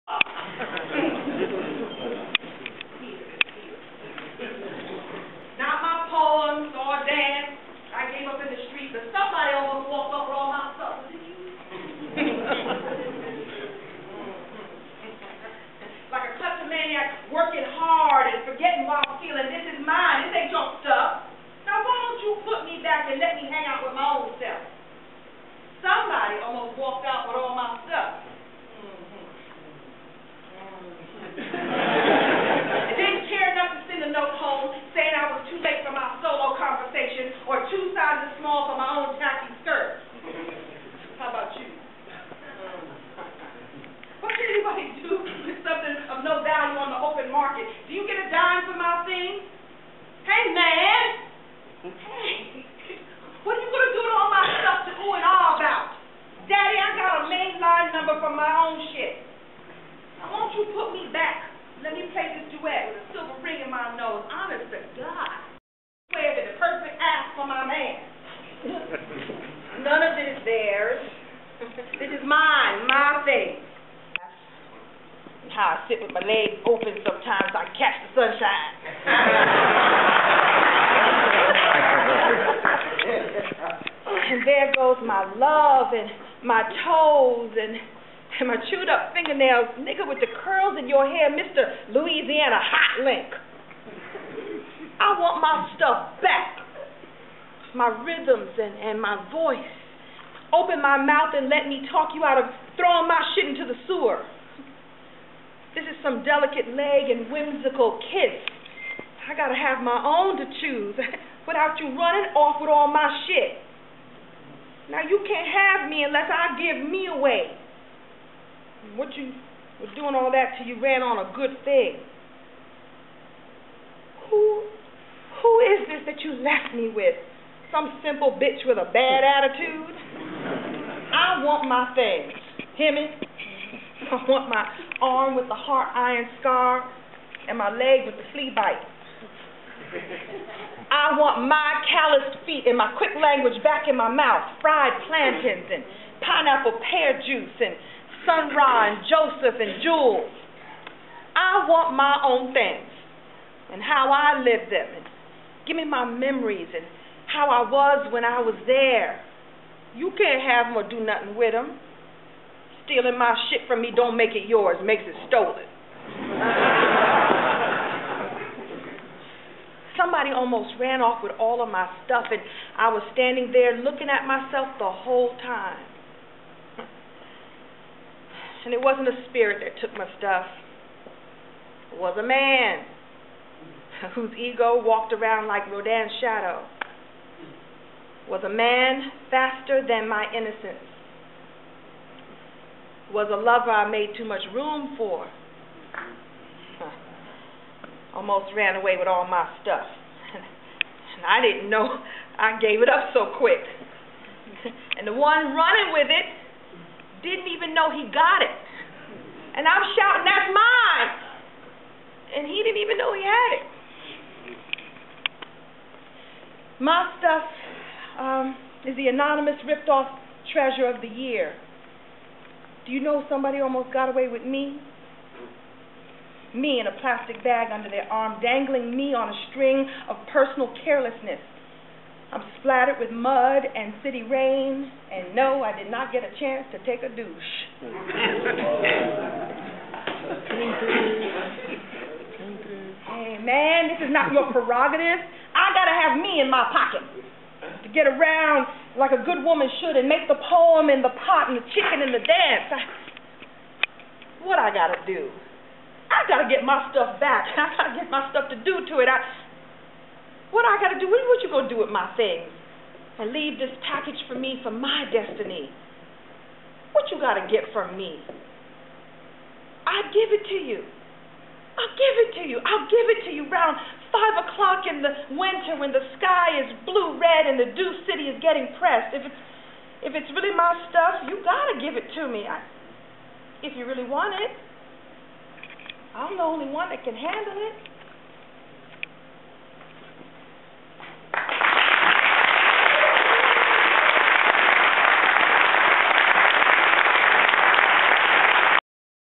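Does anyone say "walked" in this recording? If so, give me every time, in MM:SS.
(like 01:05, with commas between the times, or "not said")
00:26, 03:04.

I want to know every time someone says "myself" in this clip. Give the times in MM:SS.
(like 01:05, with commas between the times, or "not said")
02:54.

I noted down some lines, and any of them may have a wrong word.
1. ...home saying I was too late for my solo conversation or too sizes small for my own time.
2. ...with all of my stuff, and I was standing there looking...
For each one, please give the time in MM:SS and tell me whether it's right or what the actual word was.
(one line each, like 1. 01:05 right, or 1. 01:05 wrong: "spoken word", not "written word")
1. 00:34 right
2. 02:51 right.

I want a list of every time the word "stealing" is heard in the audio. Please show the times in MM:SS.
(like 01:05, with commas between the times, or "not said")
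00:19, 02:42.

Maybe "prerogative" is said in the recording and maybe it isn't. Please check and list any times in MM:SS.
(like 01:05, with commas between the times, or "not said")
04:04.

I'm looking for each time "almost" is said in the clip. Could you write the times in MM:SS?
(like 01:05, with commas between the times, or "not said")
00:26, 02:50, 03:18, 03:43.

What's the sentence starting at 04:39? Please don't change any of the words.
If it's if it's really my stuff, you gotta give it to me.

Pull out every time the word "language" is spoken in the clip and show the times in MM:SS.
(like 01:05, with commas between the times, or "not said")
02:23.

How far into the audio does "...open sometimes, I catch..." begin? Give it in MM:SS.
01:16.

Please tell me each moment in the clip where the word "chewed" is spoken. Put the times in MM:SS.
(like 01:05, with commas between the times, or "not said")
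01:28.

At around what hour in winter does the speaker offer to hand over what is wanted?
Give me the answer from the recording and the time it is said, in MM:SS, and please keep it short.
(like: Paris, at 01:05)
5 o'clock, at 04:34.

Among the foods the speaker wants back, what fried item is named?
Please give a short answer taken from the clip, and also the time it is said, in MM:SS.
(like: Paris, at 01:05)
fried plantains, at 02:24.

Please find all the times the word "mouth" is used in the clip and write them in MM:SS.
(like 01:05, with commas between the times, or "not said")
01:40, 02:24.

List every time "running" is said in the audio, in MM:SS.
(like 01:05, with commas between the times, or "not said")
01:51, 03:25.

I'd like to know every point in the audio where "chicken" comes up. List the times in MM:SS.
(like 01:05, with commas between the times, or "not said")
04:11.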